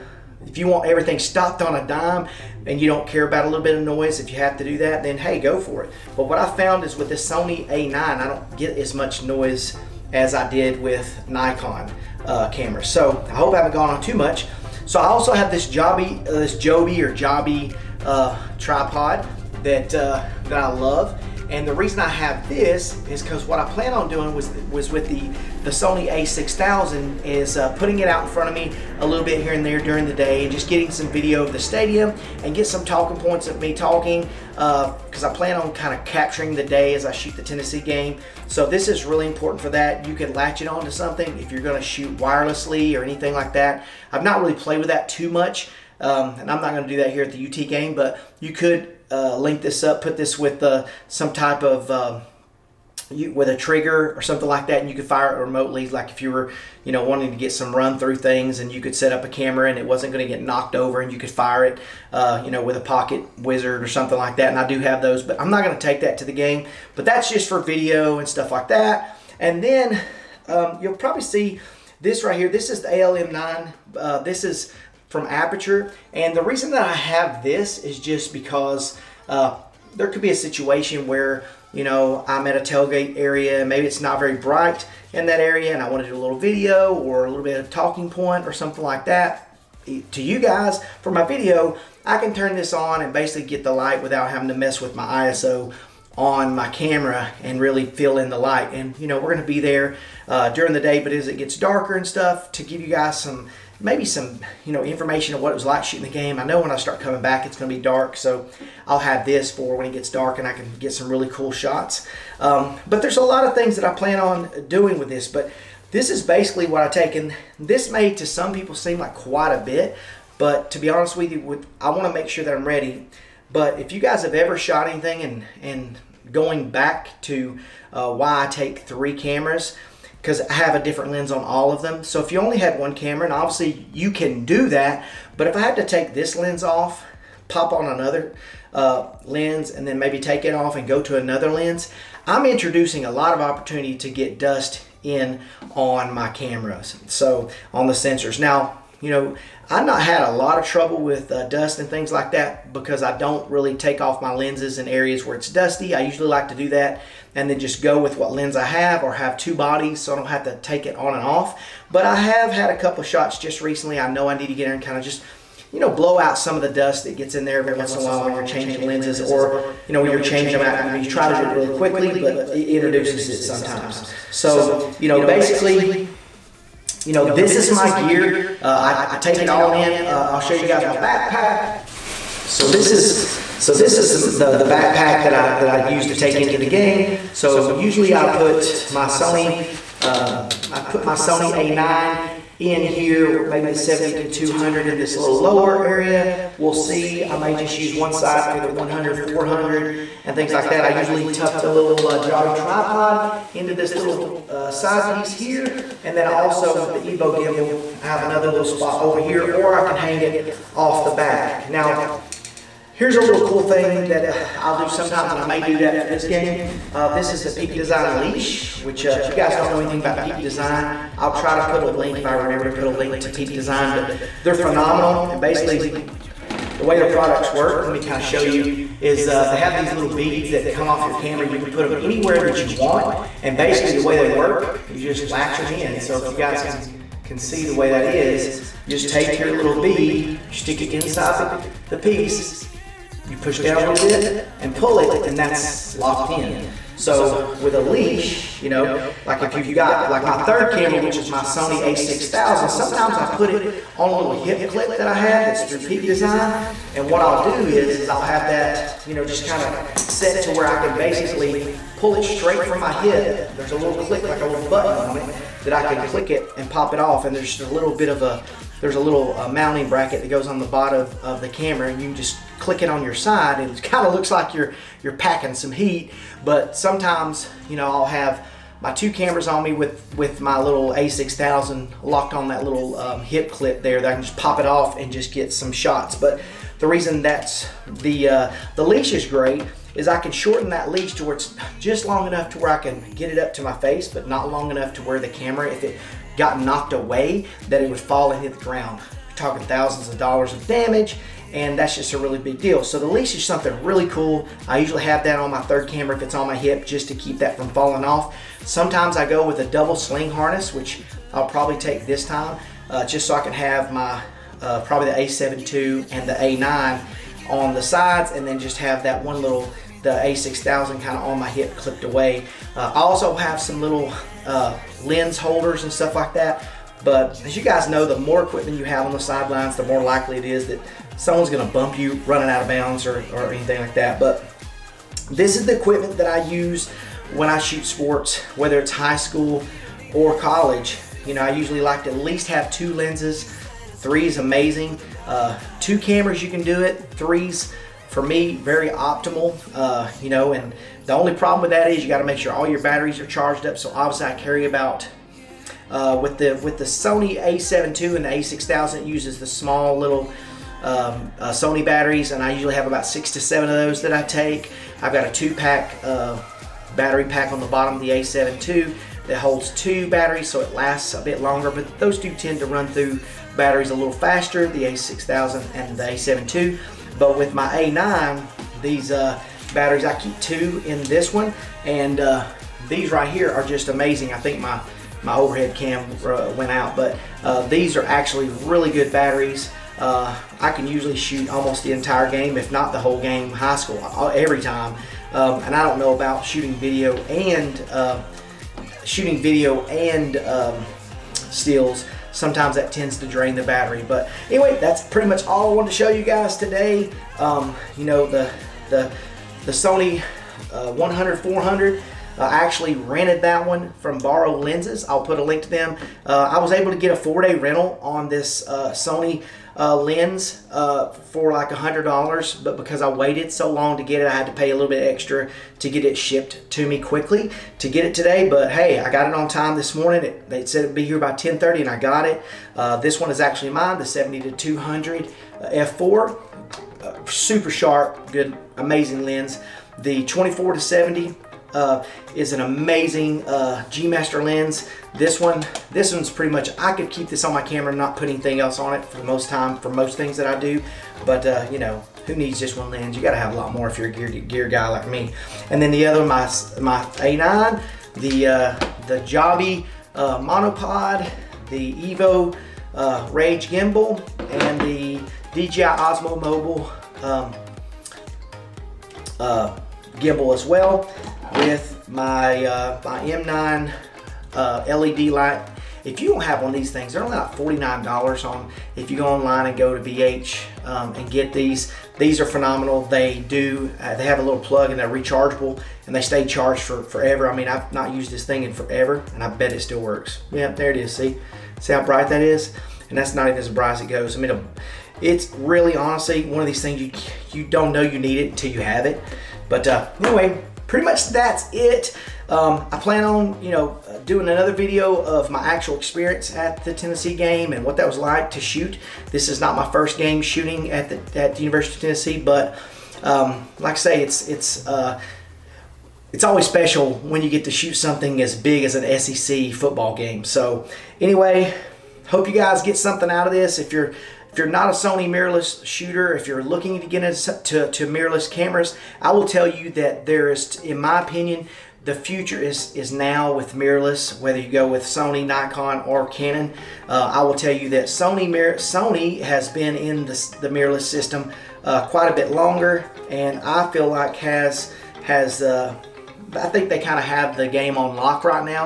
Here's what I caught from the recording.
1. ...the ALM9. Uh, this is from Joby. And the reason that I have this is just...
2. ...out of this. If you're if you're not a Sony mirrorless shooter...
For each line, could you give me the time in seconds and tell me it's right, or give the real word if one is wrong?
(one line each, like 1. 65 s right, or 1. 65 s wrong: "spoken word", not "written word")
1. 72 s wrong: "Aputure", not "Joby"
2. 523 s right.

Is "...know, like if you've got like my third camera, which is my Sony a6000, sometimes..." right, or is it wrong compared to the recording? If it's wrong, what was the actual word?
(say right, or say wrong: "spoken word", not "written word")
right.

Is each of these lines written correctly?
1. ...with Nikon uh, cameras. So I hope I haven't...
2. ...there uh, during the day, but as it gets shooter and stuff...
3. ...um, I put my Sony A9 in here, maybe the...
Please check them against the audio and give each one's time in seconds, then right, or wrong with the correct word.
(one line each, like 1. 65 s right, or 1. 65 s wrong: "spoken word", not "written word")
1. 10 s right
2. 99 s wrong: "darker", not "shooter"
3. 190 s right.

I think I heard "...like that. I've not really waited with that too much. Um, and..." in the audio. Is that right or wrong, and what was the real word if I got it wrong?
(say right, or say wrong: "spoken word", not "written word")
wrong: "played", not "waited".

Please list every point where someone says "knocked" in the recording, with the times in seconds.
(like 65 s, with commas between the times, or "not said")
60 s, 296 s.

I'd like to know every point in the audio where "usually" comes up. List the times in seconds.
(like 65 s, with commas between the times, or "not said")
156 s, 187 s, 200 s, 304 s, 341 s, 362 s, 390 s.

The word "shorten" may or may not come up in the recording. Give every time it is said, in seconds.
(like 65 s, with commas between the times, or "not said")
290 s.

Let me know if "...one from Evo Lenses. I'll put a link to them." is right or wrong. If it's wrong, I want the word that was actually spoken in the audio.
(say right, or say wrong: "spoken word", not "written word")
wrong: "Borrow", not "Evo".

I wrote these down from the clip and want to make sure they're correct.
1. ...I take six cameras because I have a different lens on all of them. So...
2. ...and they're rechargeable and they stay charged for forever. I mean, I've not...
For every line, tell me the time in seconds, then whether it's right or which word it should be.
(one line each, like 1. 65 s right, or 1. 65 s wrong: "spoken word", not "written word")
1. 128 s wrong: "three", not "six"
2. 484 s right.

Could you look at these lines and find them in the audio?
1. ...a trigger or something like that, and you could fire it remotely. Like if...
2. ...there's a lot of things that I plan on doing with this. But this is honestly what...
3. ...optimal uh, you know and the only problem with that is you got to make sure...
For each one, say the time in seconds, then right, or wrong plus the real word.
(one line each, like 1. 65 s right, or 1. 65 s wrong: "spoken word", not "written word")
1. 53 s right
2. 113 s wrong: "basically", not "honestly"
3. 348 s right.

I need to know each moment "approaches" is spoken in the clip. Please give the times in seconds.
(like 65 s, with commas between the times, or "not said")
not said.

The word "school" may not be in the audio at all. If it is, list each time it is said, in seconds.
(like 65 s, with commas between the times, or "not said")
339 s, 393 s.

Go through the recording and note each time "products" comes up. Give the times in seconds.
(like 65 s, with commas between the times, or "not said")
227 s.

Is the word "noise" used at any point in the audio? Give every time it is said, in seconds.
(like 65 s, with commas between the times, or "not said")
3 s, 9 s.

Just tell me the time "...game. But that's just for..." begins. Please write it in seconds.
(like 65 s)
66 s.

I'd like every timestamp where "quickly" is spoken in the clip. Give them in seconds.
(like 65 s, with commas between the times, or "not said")
171 s, 426 s.